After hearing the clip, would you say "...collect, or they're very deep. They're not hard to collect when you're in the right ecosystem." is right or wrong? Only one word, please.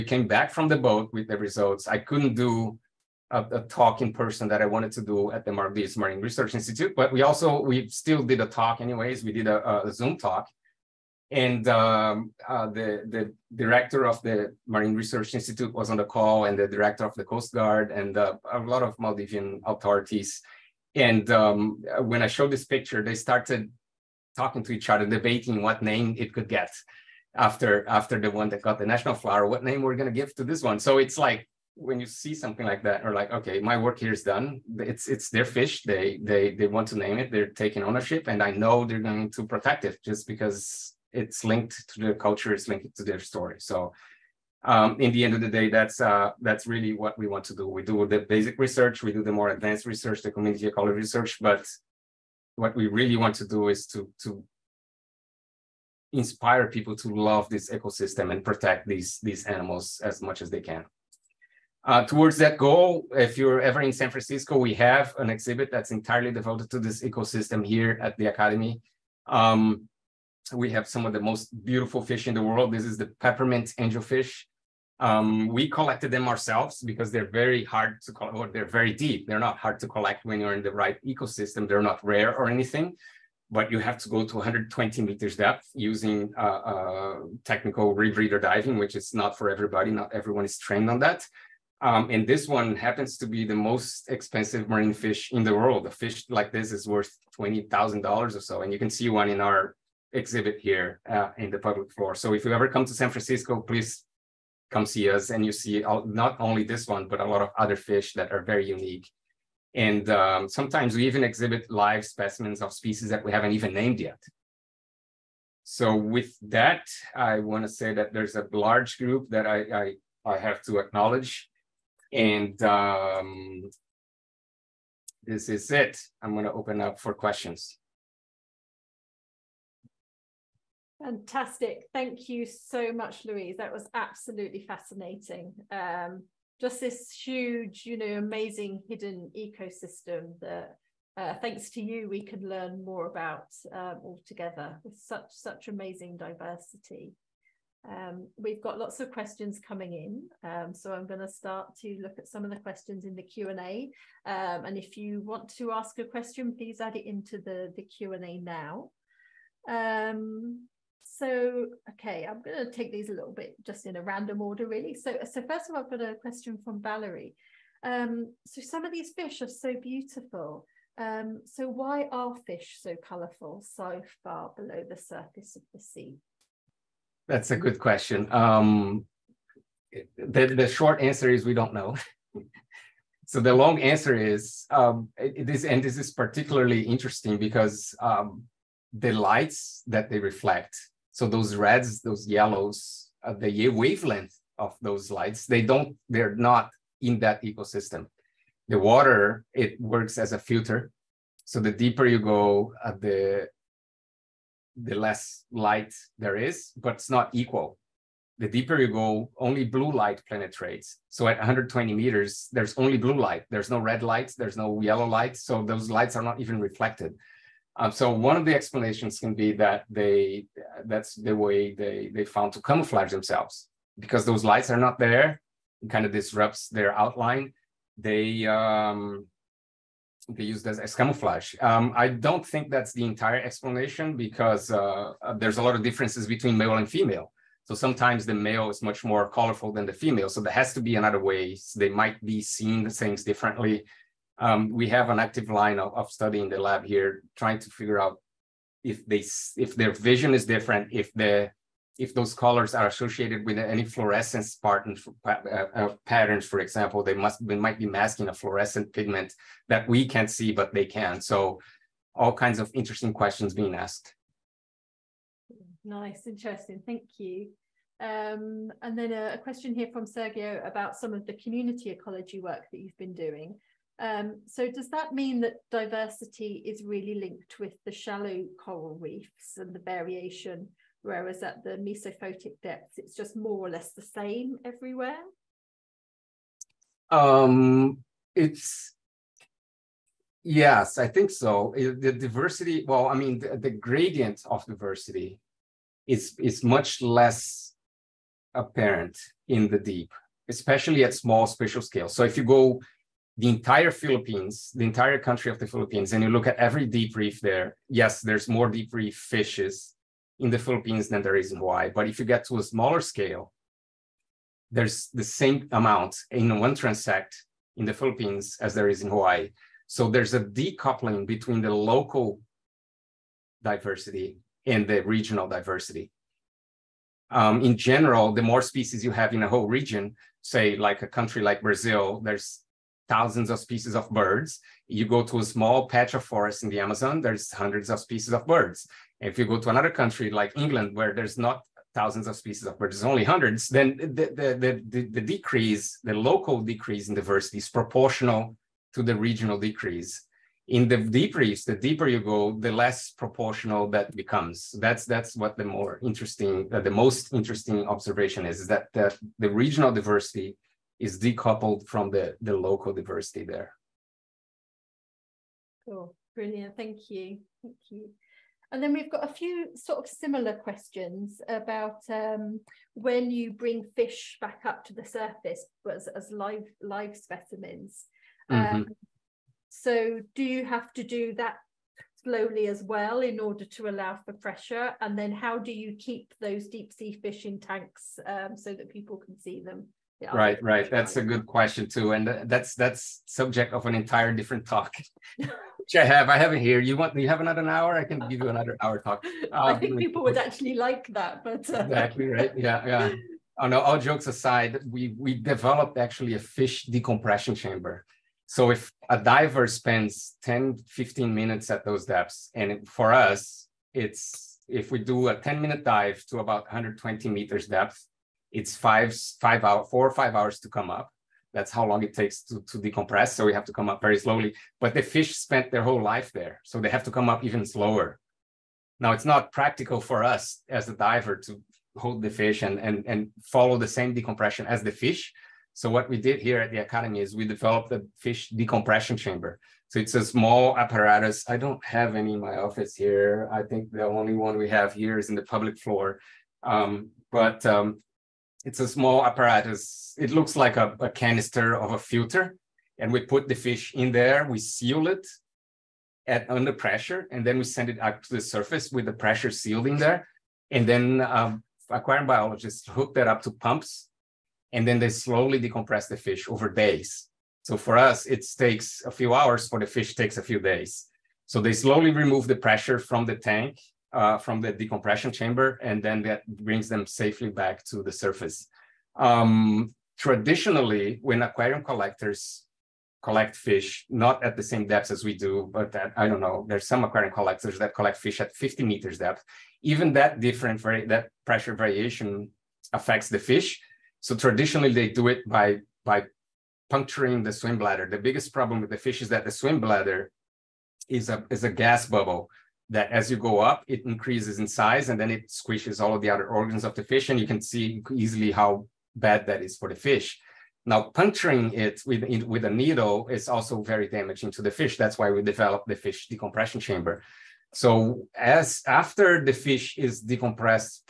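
right.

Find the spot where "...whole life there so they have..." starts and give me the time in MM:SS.
07:05.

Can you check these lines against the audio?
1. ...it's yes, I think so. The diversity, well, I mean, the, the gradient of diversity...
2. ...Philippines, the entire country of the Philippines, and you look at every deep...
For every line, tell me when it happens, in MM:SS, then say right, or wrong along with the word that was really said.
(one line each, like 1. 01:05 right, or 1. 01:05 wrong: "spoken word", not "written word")
1. 04:48 right
2. 05:03 right.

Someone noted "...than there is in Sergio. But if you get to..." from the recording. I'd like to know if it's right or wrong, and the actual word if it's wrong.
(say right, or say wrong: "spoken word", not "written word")
wrong: "Hawaii", not "Sergio".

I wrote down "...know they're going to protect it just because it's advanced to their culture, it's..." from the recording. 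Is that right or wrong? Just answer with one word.
wrong.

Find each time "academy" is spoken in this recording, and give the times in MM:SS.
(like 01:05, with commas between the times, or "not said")
01:08, 07:16.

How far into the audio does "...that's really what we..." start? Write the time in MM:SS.
00:46.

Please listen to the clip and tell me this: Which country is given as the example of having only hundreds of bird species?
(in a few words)
England.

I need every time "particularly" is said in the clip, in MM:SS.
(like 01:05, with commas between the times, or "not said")
03:06.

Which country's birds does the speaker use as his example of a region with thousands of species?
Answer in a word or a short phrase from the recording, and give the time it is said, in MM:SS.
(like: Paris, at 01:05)
Brazil, at 05:31.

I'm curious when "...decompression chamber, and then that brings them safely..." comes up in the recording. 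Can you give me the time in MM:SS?
07:54.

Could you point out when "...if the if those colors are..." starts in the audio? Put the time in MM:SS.
04:10.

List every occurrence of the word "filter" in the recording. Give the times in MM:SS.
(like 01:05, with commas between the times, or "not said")
03:20, 07:31.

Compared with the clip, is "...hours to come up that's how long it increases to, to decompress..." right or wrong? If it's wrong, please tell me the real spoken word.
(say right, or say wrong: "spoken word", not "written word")
wrong: "takes", not "increases".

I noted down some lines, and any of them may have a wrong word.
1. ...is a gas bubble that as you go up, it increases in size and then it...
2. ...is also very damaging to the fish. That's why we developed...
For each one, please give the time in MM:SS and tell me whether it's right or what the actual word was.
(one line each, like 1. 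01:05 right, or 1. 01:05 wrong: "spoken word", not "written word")
1. 08:21 right
2. 08:33 right.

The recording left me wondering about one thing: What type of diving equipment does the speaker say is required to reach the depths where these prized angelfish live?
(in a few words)
technical rebreather.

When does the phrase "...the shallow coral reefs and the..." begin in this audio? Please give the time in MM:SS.
04:37.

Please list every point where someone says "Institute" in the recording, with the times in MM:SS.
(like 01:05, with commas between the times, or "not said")
00:06, 00:15.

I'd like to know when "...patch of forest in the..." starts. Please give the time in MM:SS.
05:35.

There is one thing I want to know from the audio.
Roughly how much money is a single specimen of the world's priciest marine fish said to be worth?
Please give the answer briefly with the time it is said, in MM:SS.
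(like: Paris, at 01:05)
$20,000, at 01:37.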